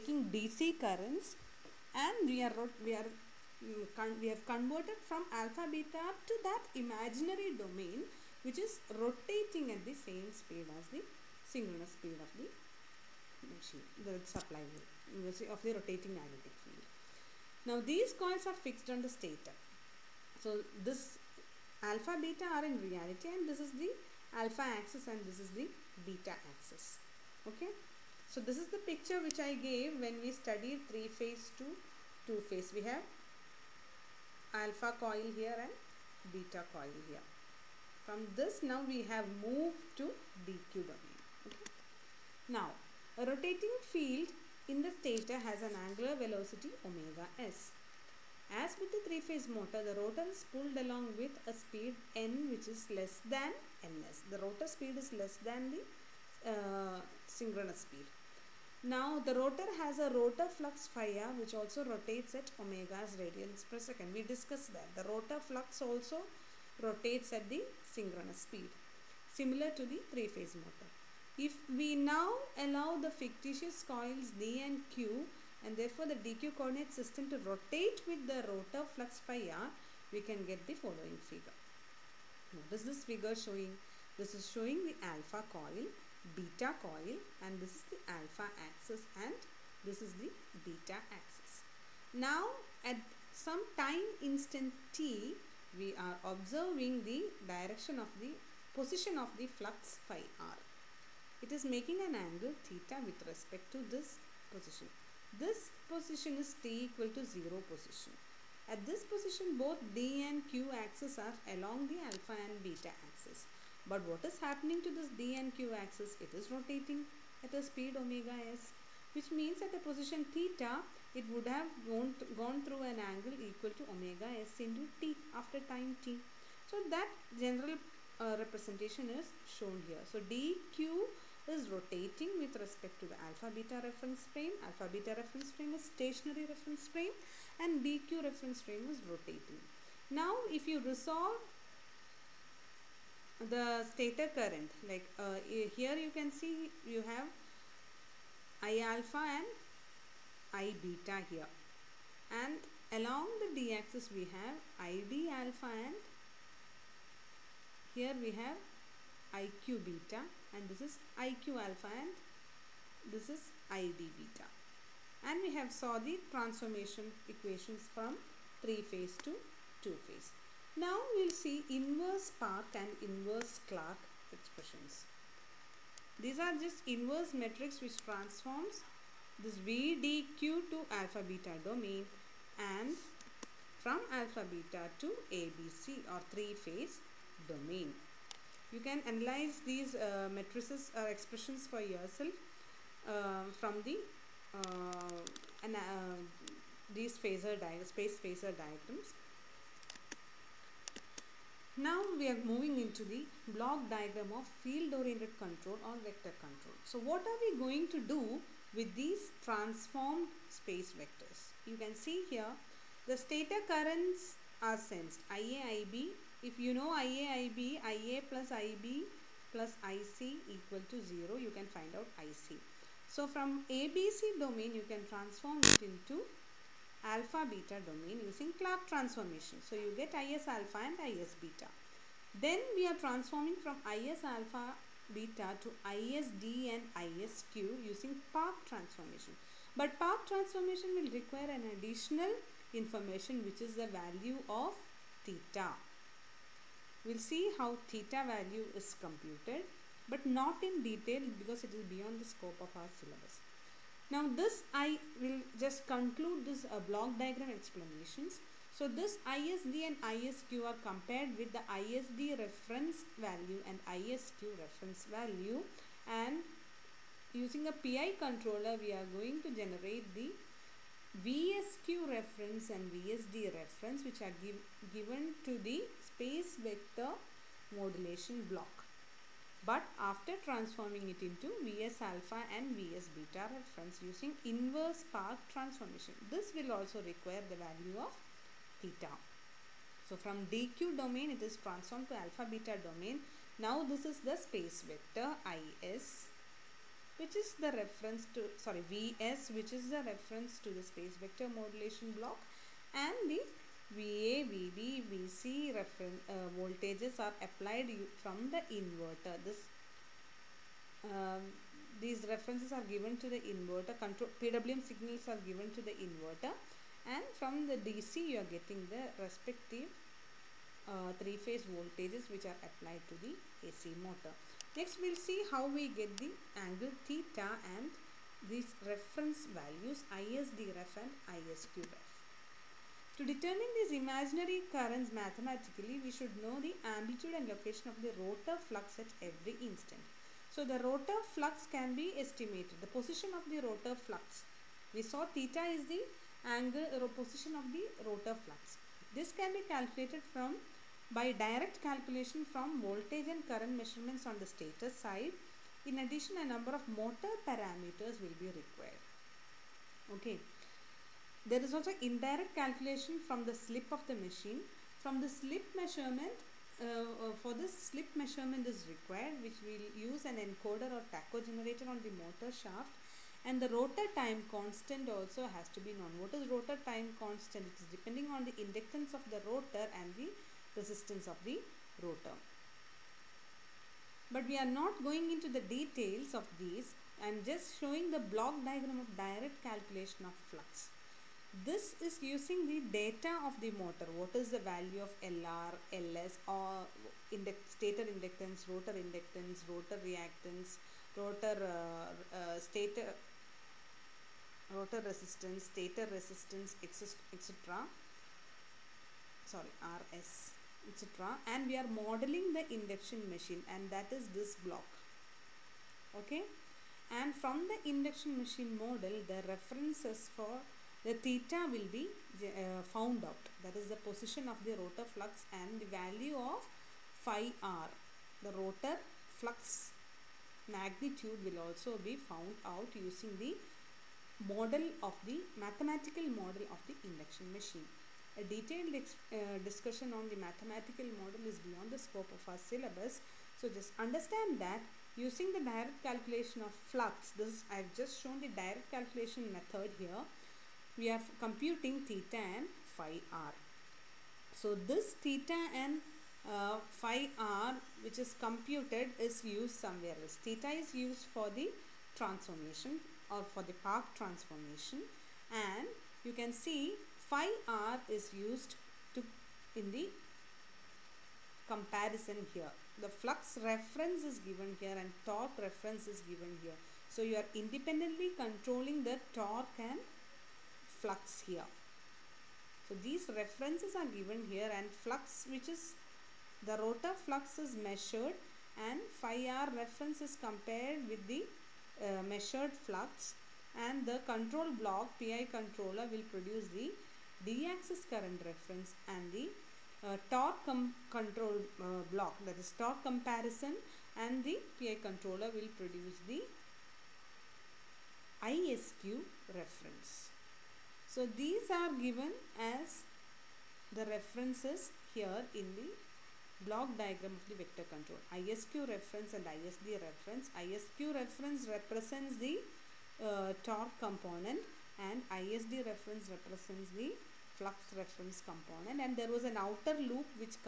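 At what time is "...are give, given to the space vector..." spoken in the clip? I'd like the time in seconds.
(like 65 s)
274 s.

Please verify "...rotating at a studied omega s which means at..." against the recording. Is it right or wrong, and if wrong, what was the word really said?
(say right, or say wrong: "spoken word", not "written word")
wrong: "speed", not "studied".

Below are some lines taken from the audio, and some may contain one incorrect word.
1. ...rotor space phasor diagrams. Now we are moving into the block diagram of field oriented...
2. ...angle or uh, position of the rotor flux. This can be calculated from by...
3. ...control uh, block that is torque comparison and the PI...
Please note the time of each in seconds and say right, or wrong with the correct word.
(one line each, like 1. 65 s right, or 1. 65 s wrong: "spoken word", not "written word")
1. 197 s wrong: "phasor", not "rotor"
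2. 346 s right
3. 501 s right.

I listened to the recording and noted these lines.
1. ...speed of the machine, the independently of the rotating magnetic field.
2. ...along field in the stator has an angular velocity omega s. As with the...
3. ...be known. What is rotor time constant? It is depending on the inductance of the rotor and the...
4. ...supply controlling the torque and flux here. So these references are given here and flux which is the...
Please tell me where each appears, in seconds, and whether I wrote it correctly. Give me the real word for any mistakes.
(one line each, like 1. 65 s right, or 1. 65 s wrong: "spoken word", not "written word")
1. 11 s wrong: "supply", not "independently"
2. 43 s wrong: "rotating", not "along"
3. 375 s right
4. 477 s wrong: "independently", not "supply".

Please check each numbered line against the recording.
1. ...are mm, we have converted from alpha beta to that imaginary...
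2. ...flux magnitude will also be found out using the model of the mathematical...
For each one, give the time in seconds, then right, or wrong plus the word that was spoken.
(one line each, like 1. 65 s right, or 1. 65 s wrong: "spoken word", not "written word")
1. 2 s right
2. 429 s right.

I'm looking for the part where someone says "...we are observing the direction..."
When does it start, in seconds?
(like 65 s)
95 s.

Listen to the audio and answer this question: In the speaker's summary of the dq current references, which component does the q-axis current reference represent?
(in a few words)
torque component.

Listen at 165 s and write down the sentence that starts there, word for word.
And we have saw the transformation equations from 3 phase to 2 phase.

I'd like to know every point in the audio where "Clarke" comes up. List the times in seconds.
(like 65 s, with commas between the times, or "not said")
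173 s, 228 s.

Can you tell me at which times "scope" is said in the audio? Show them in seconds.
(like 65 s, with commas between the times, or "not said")
252 s, 441 s.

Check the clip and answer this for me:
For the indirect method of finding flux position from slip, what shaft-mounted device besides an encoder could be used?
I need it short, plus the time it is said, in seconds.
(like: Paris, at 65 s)
tacho generator, at 371 s.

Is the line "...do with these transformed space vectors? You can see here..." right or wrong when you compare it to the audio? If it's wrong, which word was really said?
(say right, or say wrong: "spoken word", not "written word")
right.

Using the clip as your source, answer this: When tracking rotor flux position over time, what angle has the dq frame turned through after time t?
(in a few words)
omega s into t.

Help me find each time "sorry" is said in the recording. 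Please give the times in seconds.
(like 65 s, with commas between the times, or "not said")
298 s, 409 s.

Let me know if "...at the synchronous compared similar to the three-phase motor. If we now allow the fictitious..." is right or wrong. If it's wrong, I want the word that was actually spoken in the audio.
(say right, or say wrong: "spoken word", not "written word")
wrong: "speed", not "compared".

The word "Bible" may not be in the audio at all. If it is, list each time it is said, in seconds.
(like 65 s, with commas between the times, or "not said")
not said.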